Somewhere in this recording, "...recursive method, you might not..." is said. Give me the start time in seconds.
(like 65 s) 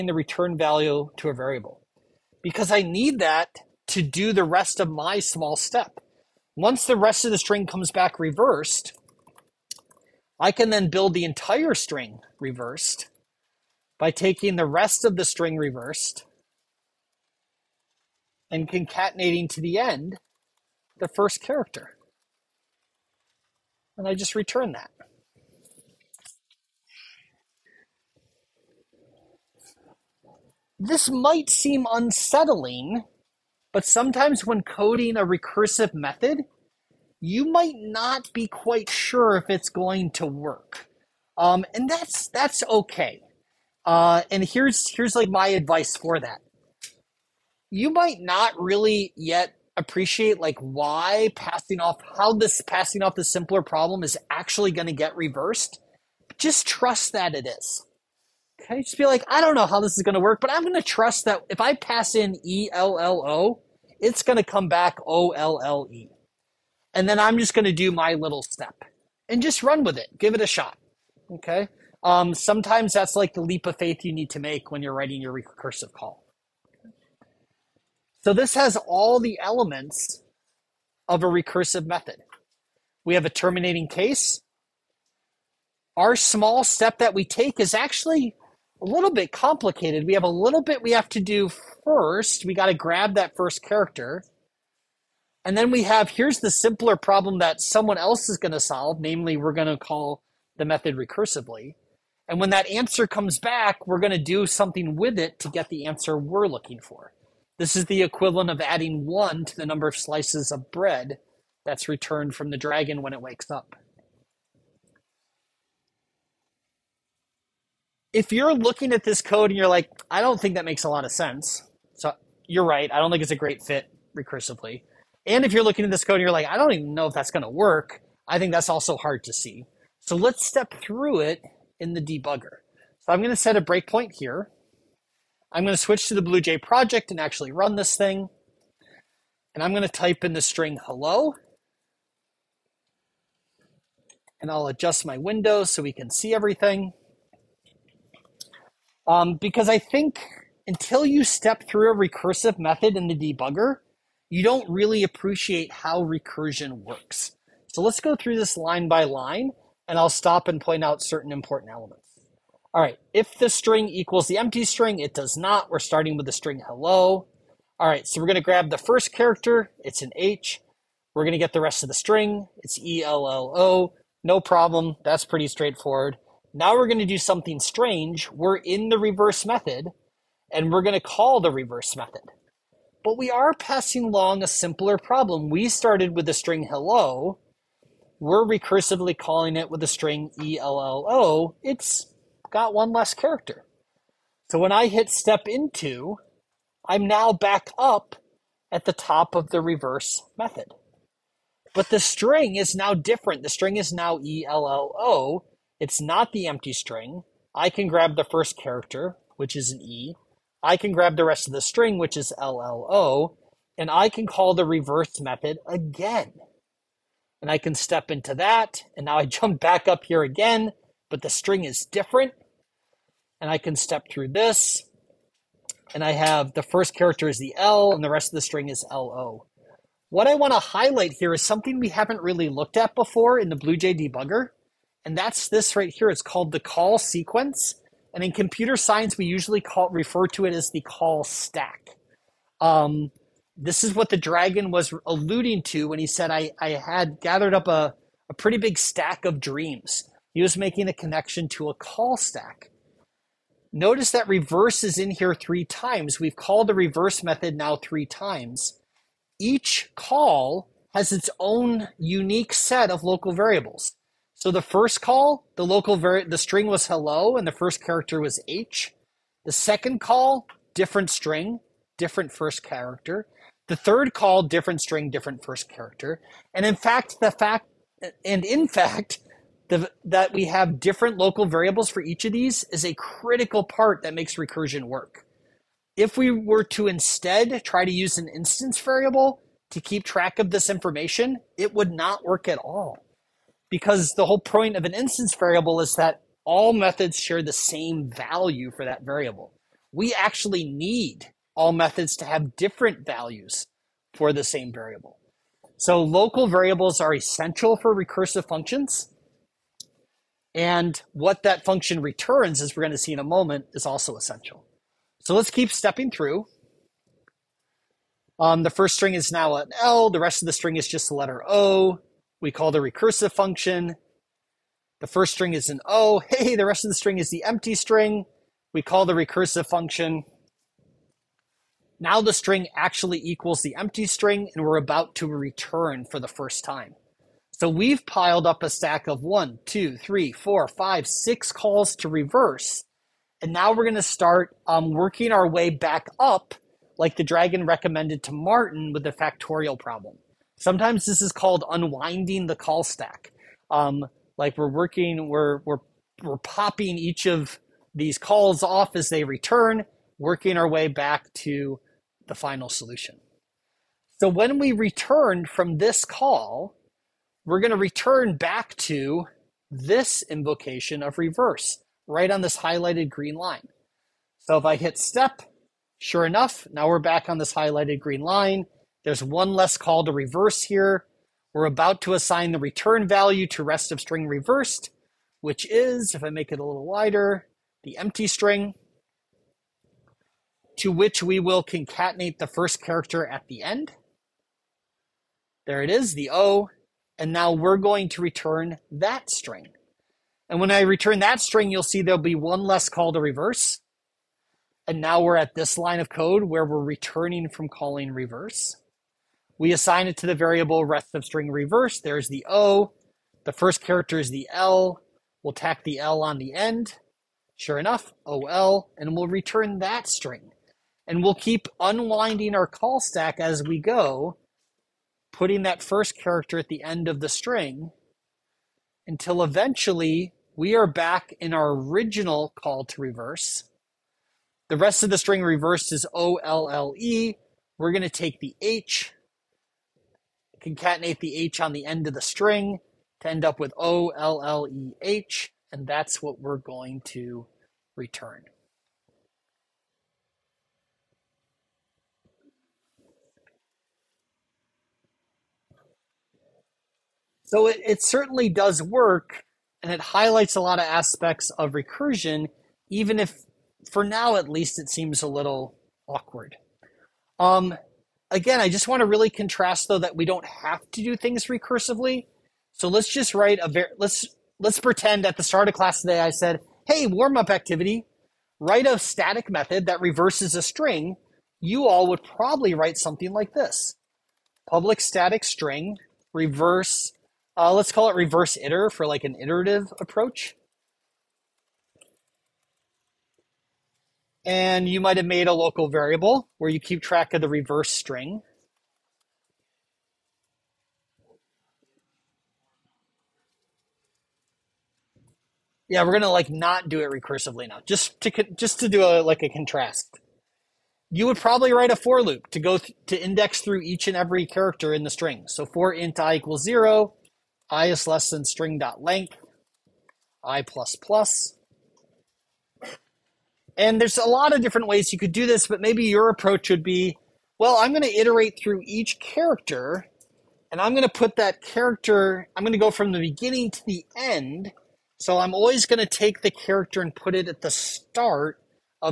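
35 s.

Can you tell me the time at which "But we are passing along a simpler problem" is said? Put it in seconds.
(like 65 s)
183 s.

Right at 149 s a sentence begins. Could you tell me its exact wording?
Um, because I think until you step through a recursive method in the debugger, you don't really appreciate how recursion works.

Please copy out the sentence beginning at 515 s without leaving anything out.
So for int i equals zero, i is less than string dot length, i plus plus.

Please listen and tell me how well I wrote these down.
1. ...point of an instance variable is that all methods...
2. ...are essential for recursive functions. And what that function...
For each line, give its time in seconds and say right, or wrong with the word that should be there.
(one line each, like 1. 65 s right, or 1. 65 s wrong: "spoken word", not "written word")
1. 294 s right
2. 307 s right.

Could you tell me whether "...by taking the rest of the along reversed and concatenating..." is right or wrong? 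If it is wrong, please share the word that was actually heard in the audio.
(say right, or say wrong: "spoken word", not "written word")
wrong: "string", not "along".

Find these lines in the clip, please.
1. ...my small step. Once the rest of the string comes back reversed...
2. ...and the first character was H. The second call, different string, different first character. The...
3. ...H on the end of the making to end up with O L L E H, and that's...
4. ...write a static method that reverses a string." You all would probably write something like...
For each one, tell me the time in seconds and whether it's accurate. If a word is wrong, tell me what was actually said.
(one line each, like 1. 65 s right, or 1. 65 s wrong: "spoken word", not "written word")
1. 4 s right
2. 267 s right
3. 441 s wrong: "string", not "making"
4. 478 s right.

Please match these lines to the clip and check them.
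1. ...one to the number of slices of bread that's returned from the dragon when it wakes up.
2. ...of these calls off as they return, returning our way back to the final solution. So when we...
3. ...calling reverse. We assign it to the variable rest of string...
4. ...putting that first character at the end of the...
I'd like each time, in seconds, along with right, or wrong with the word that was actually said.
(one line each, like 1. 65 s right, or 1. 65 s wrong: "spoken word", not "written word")
1. 109 s right
2. 357 s wrong: "working", not "returning"
3. 407 s right
4. 425 s right.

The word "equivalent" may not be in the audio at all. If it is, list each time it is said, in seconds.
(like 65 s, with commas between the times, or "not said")
108 s.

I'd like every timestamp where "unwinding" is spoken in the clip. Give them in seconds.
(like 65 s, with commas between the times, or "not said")
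351 s, 421 s.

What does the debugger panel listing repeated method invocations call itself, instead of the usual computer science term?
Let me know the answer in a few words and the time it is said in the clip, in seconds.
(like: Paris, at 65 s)
call sequence, at 236 s.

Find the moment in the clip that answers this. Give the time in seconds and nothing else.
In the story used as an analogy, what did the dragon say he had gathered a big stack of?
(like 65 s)
249 s.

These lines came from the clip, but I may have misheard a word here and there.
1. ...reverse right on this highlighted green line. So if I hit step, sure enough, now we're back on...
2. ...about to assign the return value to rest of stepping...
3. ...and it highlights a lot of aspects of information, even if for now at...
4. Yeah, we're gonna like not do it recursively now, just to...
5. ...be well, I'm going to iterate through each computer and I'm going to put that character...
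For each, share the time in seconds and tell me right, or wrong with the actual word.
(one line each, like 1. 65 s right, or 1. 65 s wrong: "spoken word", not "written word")
1. 371 s right
2. 381 s wrong: "string", not "stepping"
3. 459 s wrong: "recursion", not "information"
4. 505 s right
5. 526 s wrong: "character", not "computer".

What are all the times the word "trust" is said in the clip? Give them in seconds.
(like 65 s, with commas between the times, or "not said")
56 s, 60 s.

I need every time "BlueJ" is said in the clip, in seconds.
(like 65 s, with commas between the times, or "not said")
136 s, 233 s.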